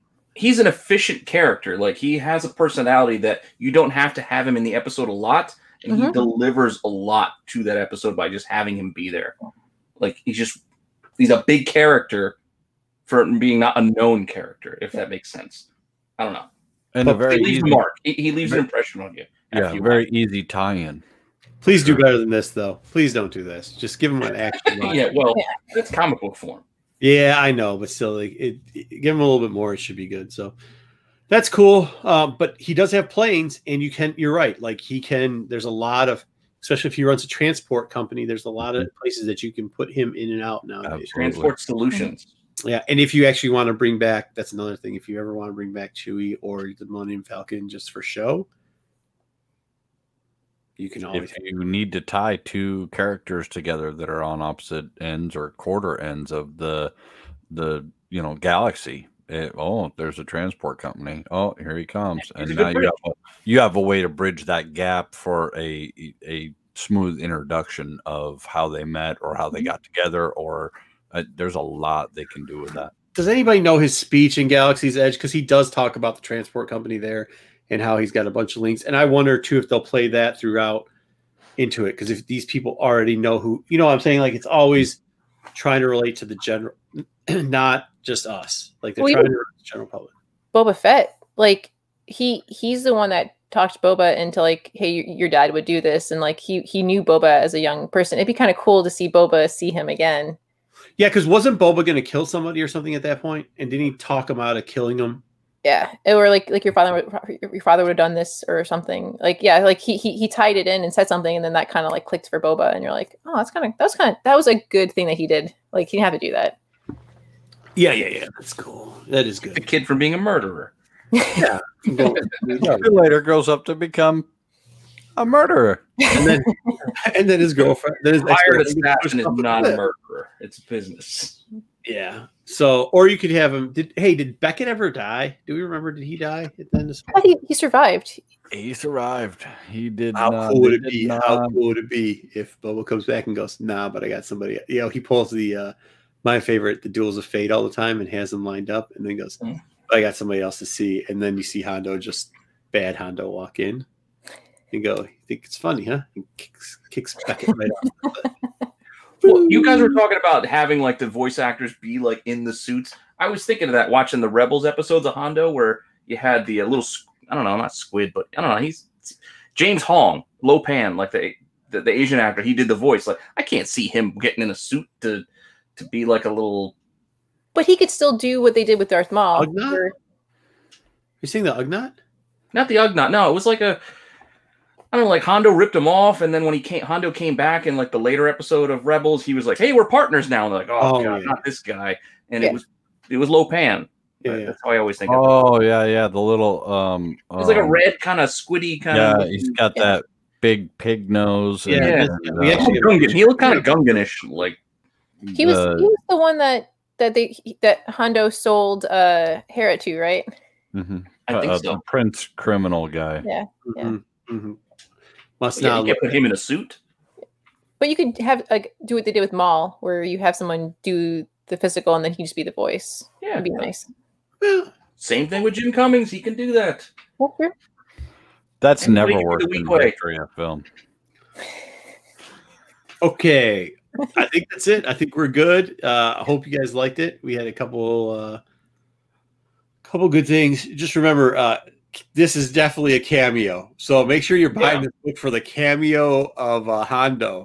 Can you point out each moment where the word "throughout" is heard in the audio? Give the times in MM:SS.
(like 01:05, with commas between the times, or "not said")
01:20.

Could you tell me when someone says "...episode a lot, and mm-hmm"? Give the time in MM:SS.
00:04.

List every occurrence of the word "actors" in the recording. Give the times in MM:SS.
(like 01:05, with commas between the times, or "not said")
02:41, 02:52.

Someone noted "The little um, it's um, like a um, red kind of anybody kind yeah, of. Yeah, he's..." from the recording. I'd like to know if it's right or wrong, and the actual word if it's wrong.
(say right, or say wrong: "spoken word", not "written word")
wrong: "squiddy", not "anybody".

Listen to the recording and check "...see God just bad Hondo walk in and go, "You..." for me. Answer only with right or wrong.
wrong.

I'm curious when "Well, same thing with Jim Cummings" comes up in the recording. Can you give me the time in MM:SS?
03:44.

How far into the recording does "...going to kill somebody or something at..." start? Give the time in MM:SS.
01:41.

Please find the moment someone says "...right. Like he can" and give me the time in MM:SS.
00:34.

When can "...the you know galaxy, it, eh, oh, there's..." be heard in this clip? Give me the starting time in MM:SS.
00:57.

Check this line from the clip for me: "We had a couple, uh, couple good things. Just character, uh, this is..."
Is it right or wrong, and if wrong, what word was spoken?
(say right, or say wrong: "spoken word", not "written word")
wrong: "remember", not "character".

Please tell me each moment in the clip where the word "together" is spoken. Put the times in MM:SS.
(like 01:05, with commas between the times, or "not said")
00:53, 01:09.